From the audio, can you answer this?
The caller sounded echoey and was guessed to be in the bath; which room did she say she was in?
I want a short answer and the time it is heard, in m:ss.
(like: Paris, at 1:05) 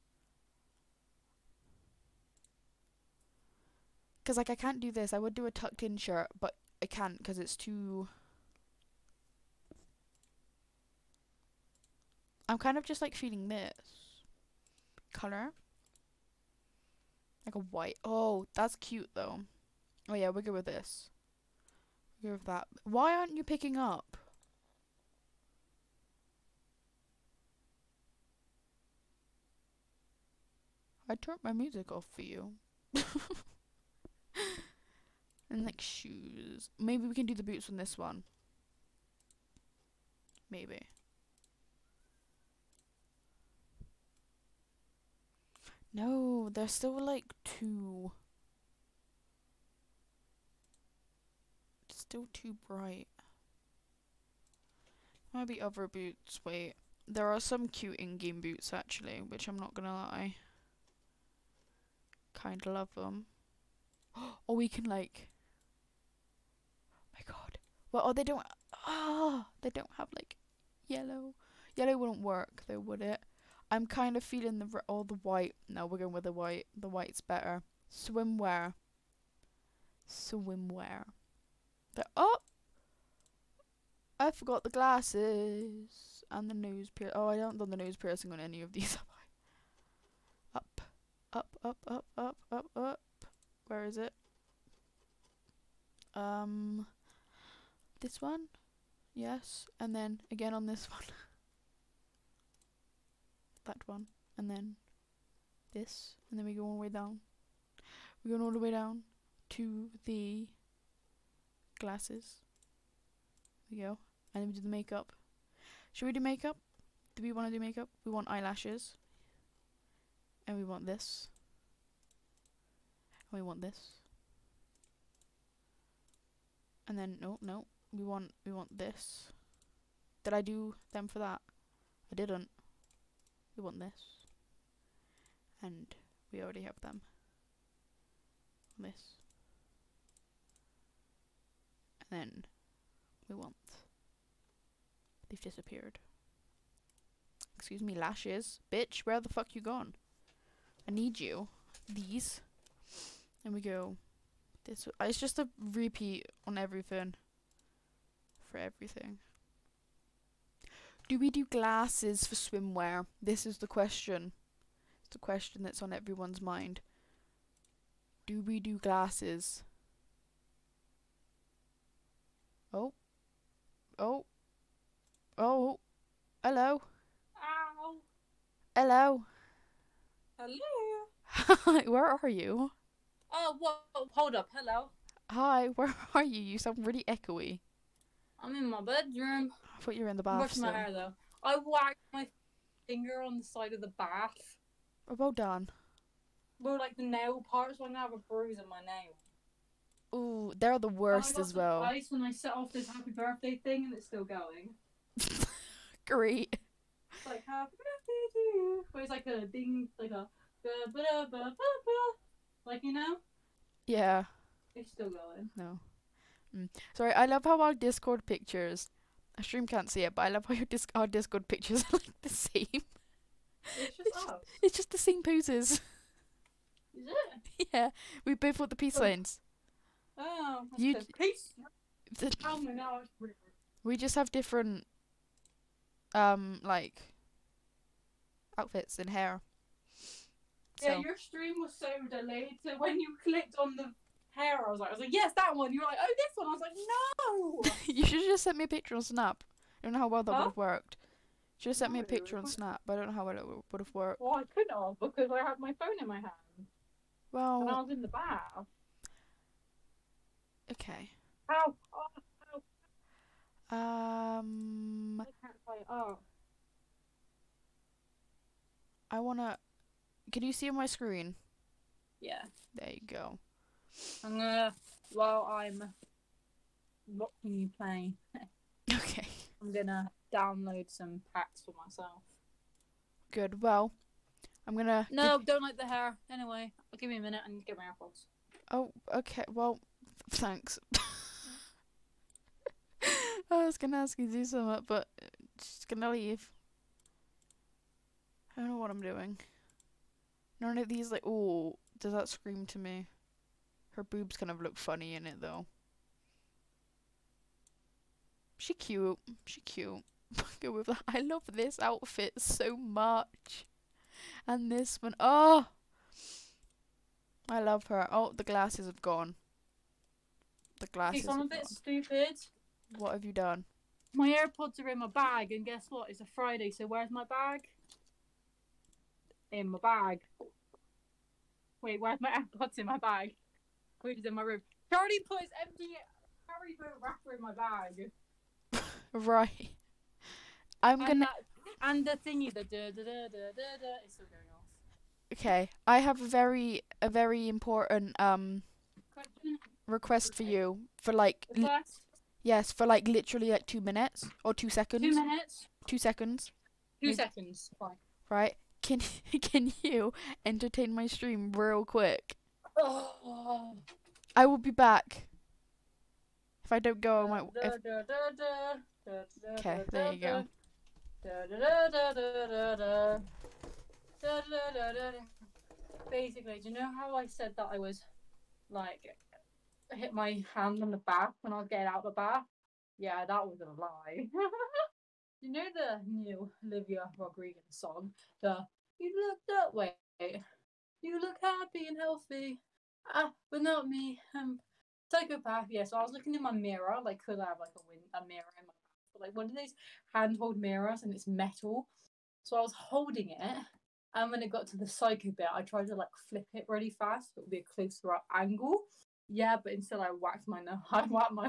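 bedroom, at 3:08.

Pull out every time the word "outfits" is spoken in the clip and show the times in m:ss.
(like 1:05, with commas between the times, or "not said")
3:58, 5:11.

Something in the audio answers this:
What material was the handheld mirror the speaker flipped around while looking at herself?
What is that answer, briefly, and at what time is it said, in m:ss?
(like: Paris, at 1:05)
metal, at 6:41.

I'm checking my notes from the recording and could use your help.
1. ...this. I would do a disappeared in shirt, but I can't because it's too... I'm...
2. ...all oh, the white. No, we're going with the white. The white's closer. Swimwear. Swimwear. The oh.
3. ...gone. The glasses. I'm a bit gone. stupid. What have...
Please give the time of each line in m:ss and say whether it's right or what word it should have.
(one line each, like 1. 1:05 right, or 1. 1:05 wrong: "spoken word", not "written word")
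1. 0:04 wrong: "tucked", not "disappeared"
2. 1:14 wrong: "better", not "closer"
3. 5:19 right.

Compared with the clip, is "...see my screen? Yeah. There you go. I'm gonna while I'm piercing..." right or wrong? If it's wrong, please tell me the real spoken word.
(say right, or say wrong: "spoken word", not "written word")
wrong: "watching", not "piercing".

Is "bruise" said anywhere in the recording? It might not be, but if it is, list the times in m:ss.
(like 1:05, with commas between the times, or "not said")
3:18.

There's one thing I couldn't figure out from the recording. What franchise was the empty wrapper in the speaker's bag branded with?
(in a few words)
Harry Potter.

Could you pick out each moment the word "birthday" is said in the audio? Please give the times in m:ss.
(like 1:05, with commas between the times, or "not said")
3:23, 3:27.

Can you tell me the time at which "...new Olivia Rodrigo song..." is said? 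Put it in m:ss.
6:26.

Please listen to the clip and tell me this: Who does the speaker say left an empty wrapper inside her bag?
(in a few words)
Charlie.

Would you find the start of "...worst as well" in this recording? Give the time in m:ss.
3:20.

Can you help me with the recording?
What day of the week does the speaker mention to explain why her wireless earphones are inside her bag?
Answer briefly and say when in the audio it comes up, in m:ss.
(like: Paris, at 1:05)
Friday, at 5:26.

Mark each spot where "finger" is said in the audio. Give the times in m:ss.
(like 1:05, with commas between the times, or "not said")
3:12.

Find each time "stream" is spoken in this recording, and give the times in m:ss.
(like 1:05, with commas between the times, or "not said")
3:39, 4:01, 6:01.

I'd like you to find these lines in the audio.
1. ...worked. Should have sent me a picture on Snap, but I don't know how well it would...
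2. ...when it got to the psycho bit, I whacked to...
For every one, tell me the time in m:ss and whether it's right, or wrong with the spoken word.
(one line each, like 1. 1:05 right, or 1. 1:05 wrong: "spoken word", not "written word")
1. 4:10 right
2. 6:44 wrong: "tried", not "whacked".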